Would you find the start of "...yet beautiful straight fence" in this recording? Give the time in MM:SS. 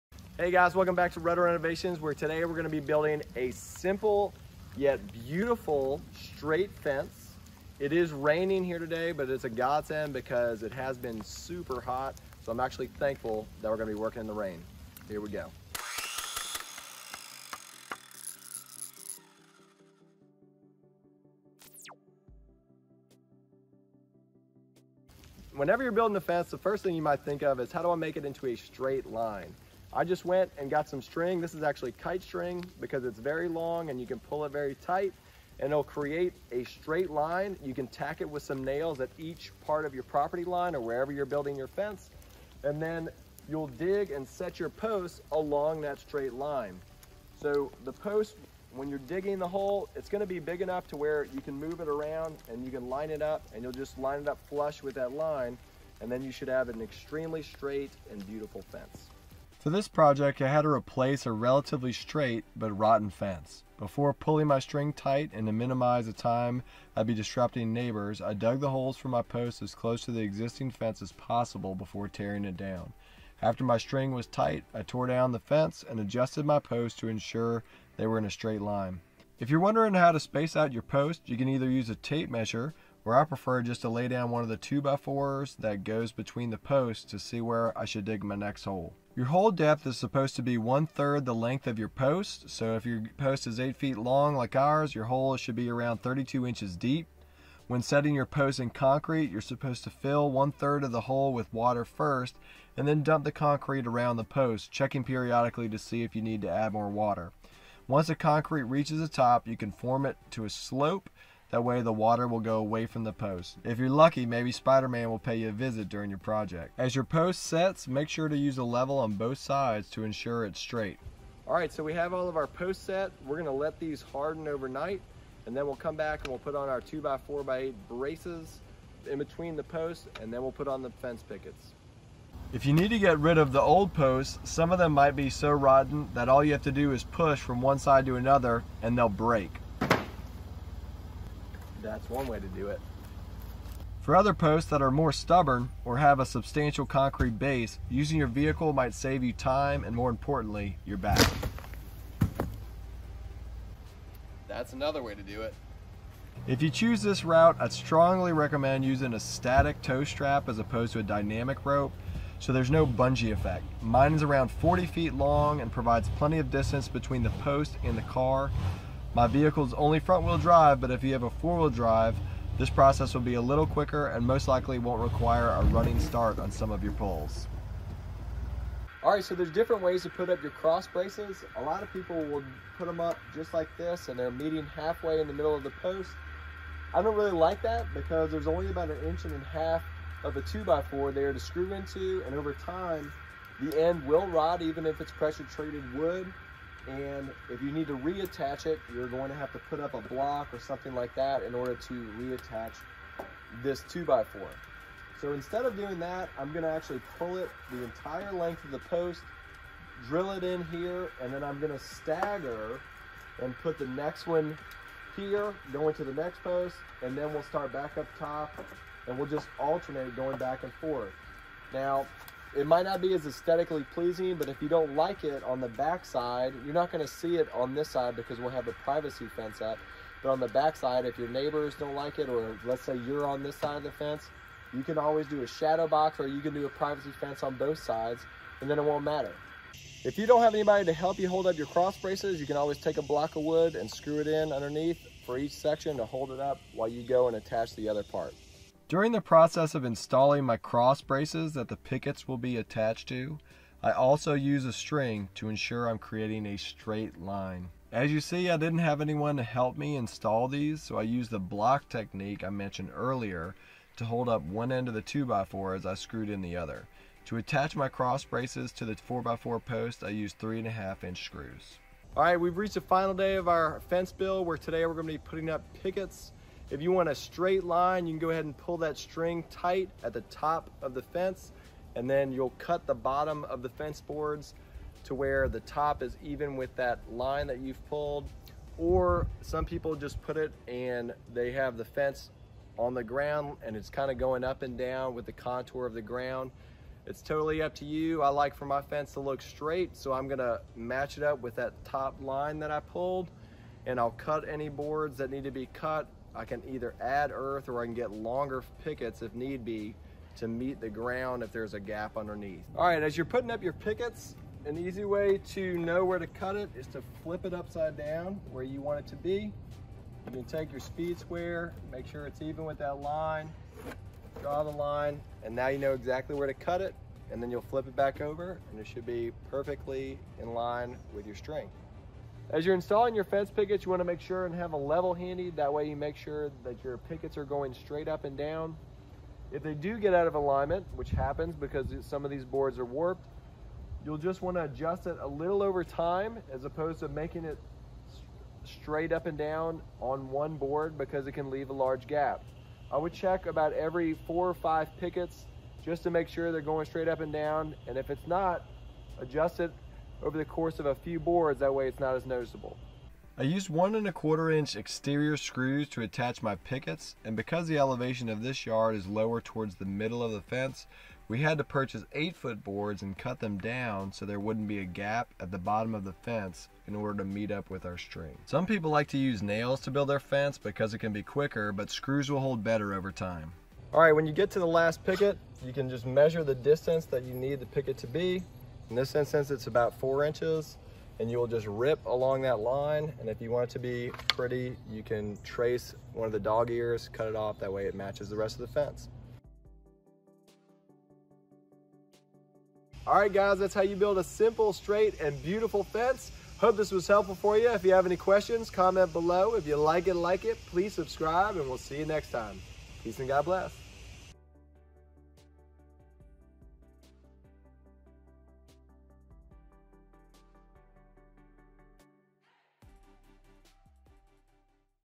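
00:04.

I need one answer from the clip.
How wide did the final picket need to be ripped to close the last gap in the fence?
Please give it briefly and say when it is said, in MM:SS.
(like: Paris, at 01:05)
4 inches, at 06:29.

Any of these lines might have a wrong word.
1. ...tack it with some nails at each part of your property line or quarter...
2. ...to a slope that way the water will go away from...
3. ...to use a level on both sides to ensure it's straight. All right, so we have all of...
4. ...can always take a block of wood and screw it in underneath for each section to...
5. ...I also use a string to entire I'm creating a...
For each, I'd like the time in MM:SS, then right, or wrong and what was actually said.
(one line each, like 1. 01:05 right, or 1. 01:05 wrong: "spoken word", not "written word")
1. 00:37 wrong: "wherever", not "quarter"
2. 01:50 right
3. 01:58 right
4. 04:02 right
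5. 04:13 wrong: "ensure", not "entire".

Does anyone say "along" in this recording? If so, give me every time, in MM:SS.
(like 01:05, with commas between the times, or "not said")
00:45, 06:32.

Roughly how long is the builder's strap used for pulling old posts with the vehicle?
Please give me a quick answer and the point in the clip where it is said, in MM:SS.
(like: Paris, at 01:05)
40 feet, at 02:44.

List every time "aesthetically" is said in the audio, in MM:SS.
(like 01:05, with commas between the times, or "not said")
03:43.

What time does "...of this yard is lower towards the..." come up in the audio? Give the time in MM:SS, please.
06:08.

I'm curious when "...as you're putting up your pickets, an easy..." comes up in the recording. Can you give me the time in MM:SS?
05:13.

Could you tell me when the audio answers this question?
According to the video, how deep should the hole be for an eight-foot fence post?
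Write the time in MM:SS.
01:36.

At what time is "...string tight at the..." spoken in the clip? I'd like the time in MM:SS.
04:38.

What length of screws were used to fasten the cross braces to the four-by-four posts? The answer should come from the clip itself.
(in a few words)
3.5 inch.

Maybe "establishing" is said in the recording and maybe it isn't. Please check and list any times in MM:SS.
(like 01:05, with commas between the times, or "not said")
not said.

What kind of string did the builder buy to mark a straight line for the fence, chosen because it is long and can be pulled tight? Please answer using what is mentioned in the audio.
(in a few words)
Kite string.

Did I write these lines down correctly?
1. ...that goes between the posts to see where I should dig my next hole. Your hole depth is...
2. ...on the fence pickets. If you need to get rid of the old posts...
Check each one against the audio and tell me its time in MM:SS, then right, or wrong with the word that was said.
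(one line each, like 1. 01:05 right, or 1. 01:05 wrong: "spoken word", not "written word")
1. 01:25 right
2. 02:10 right.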